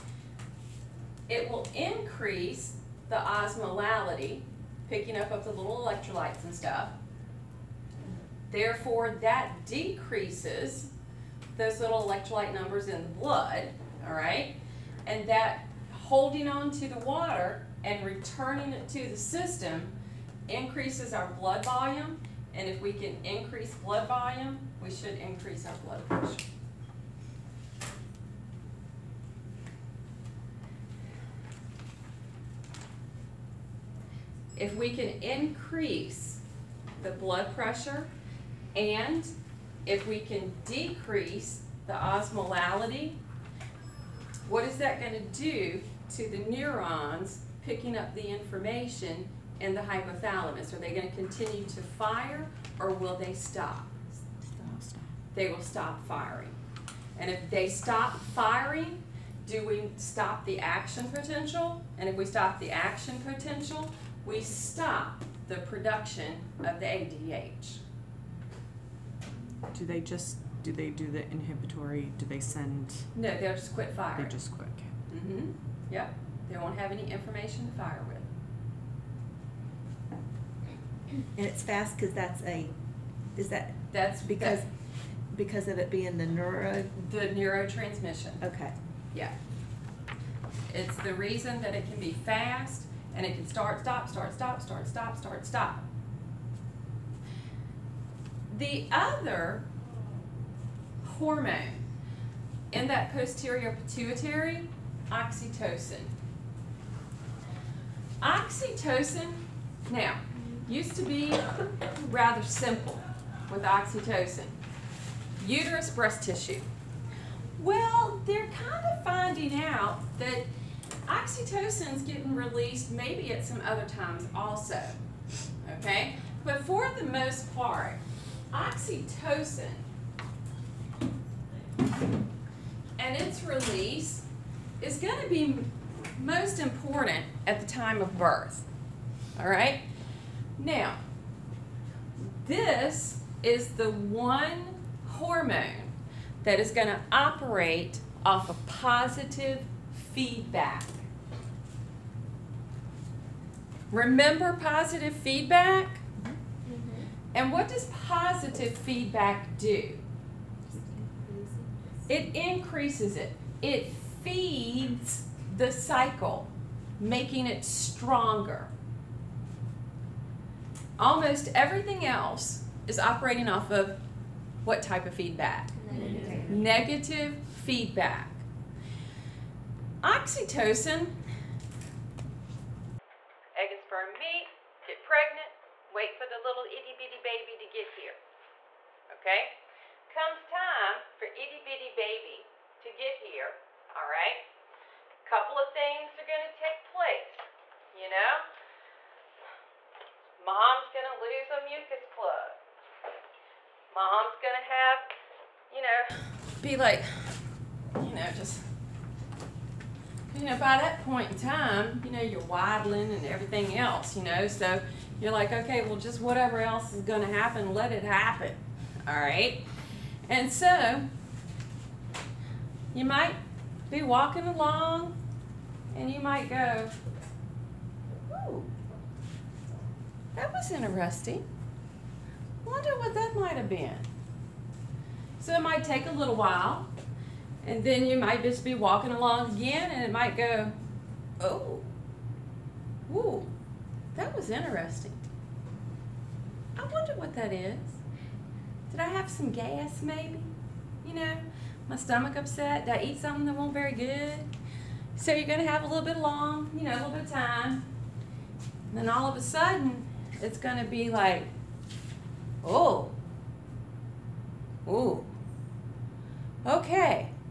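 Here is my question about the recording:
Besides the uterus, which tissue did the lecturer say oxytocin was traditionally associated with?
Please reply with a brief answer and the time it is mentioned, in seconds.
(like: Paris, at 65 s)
Breast tissue, at 115 s.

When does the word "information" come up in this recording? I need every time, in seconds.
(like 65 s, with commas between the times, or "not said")
48 s, 77 s.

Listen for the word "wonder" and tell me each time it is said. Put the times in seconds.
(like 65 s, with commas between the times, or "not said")
232 s, 246 s.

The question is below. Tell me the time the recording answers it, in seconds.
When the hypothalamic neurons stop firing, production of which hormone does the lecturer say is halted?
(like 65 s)
66 s.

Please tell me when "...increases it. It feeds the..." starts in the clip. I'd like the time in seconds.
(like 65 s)
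162 s.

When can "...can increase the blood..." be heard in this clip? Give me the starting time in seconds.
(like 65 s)
34 s.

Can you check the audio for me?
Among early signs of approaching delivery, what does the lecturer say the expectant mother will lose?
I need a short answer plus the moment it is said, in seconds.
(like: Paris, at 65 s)
A mucus plug, at 201 s.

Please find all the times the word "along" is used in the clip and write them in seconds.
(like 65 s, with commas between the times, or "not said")
224 s, 239 s.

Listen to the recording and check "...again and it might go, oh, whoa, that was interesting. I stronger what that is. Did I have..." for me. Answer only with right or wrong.
wrong.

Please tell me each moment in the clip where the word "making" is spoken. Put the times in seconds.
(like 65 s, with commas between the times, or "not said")
166 s.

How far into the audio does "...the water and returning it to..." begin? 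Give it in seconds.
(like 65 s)
16 s.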